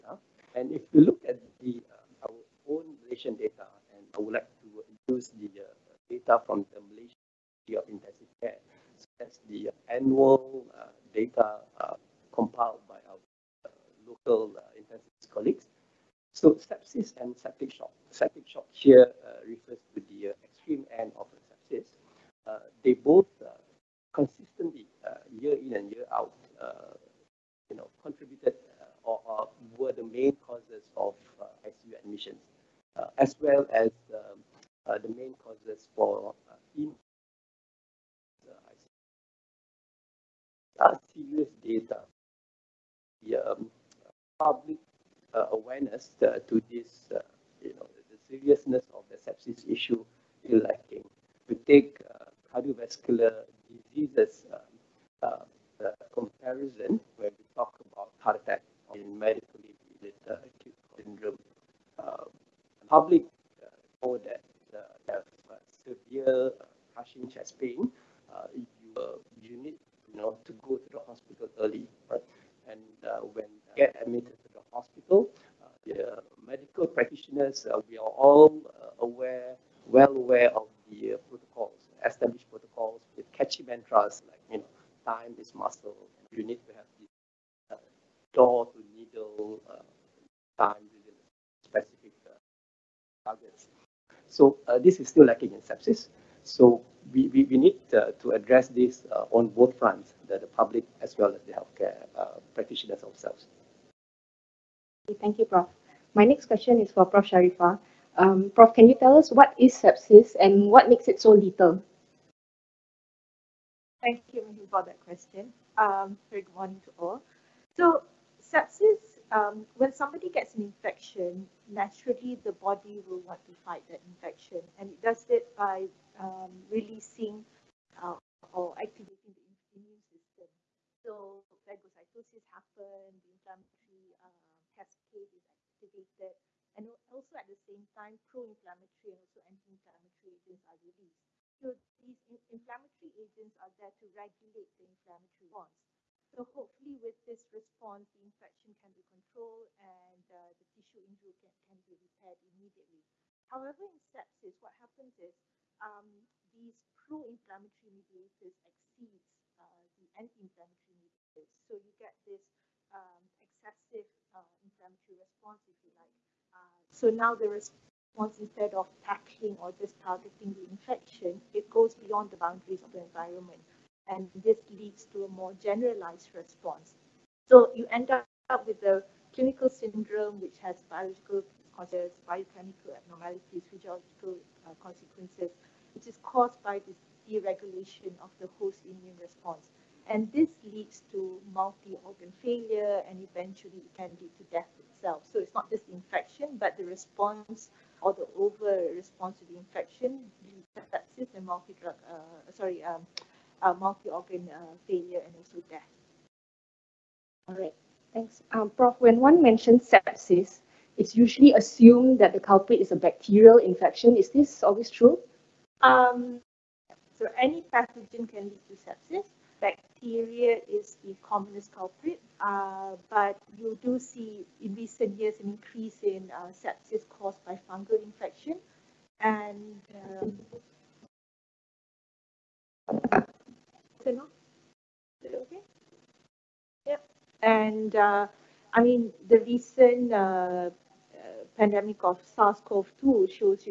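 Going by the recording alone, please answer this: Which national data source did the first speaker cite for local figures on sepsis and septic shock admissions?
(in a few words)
Malaysian Registry of Intensive Care.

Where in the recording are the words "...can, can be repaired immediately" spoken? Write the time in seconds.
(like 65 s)
151 s.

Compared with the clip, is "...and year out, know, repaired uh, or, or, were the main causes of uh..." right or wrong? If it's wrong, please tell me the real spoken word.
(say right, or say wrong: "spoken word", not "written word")
wrong: "contributed", not "repaired".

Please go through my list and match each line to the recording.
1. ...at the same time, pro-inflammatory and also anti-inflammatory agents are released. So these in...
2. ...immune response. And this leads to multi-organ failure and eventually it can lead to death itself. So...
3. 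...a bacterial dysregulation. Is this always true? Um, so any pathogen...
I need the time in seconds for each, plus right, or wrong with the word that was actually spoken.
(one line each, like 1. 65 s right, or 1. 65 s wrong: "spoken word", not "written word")
1. 137 s right
2. 188 s right
3. 212 s wrong: "infection", not "dysregulation".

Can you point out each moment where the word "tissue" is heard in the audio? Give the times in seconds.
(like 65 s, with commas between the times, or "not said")
150 s.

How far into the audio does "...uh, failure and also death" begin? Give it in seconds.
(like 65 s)
204 s.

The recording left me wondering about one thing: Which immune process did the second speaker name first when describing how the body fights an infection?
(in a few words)
phagocytosis.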